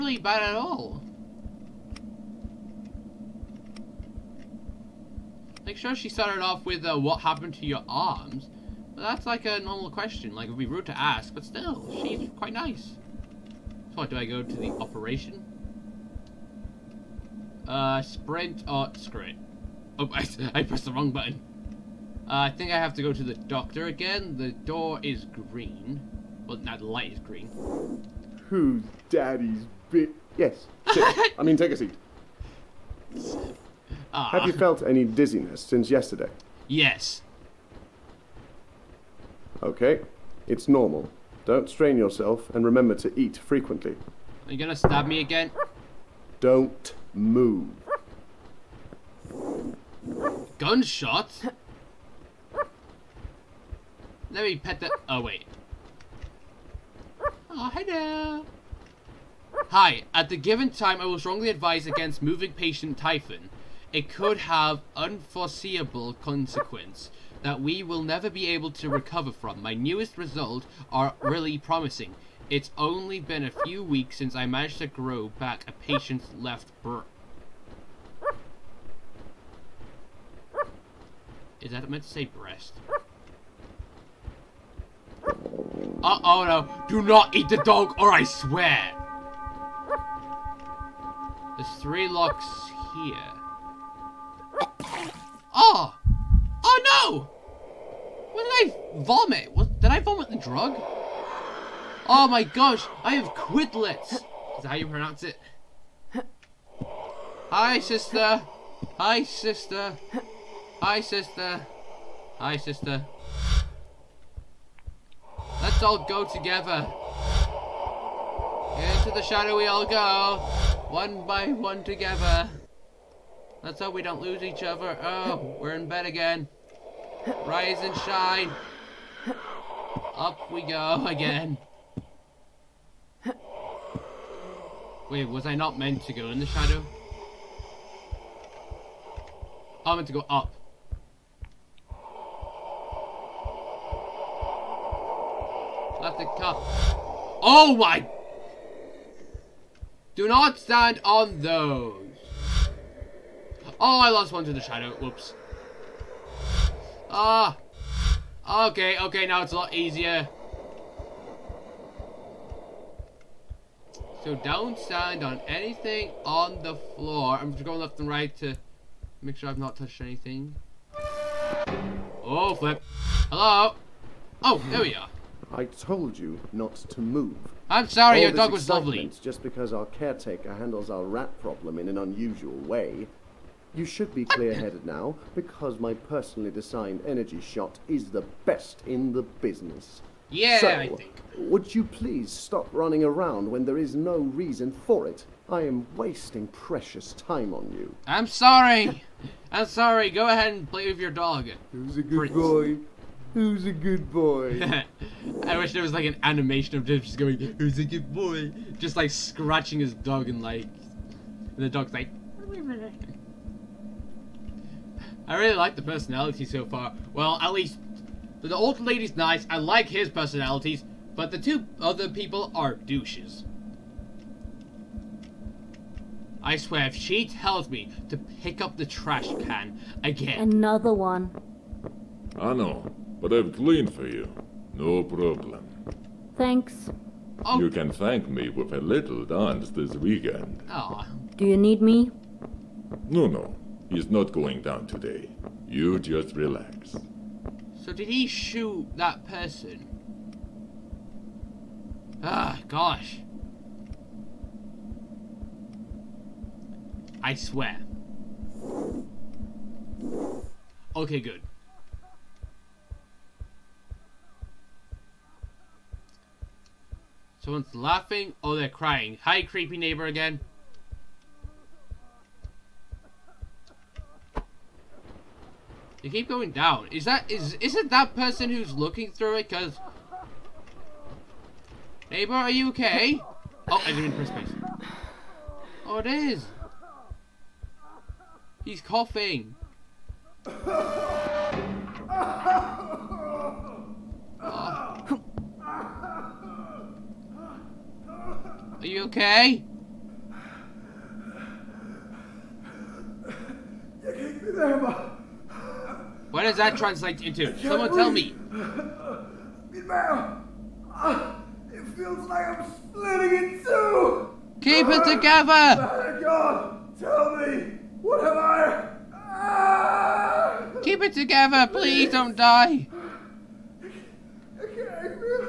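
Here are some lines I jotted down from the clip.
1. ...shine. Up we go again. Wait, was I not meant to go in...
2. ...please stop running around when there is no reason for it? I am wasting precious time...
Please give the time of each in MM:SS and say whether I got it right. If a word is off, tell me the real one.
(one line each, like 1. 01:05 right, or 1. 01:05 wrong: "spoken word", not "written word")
1. 02:07 right
2. 03:11 right.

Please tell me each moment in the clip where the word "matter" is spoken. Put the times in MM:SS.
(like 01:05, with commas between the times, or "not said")
not said.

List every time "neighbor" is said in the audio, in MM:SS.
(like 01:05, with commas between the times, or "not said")
04:29, 04:42.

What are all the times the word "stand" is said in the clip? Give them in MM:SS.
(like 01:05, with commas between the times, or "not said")
02:30, 02:44.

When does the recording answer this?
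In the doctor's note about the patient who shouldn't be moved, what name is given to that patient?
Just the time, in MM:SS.
01:02.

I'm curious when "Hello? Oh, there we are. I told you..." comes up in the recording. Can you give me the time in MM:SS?
02:53.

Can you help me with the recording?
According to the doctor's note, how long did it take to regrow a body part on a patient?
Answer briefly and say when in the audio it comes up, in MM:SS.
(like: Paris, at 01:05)
A few weeks, at 01:12.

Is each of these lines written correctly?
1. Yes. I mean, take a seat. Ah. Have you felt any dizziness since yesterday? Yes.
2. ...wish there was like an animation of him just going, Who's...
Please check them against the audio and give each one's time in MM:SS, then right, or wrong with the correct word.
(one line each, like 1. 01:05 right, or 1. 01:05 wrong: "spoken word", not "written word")
1. 00:30 right
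2. 03:25 right.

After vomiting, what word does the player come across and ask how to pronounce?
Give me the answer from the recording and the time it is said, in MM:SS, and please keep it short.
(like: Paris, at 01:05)
Quidlets, at 01:43.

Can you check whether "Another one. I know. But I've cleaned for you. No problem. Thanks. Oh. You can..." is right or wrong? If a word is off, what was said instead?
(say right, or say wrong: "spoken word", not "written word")
right.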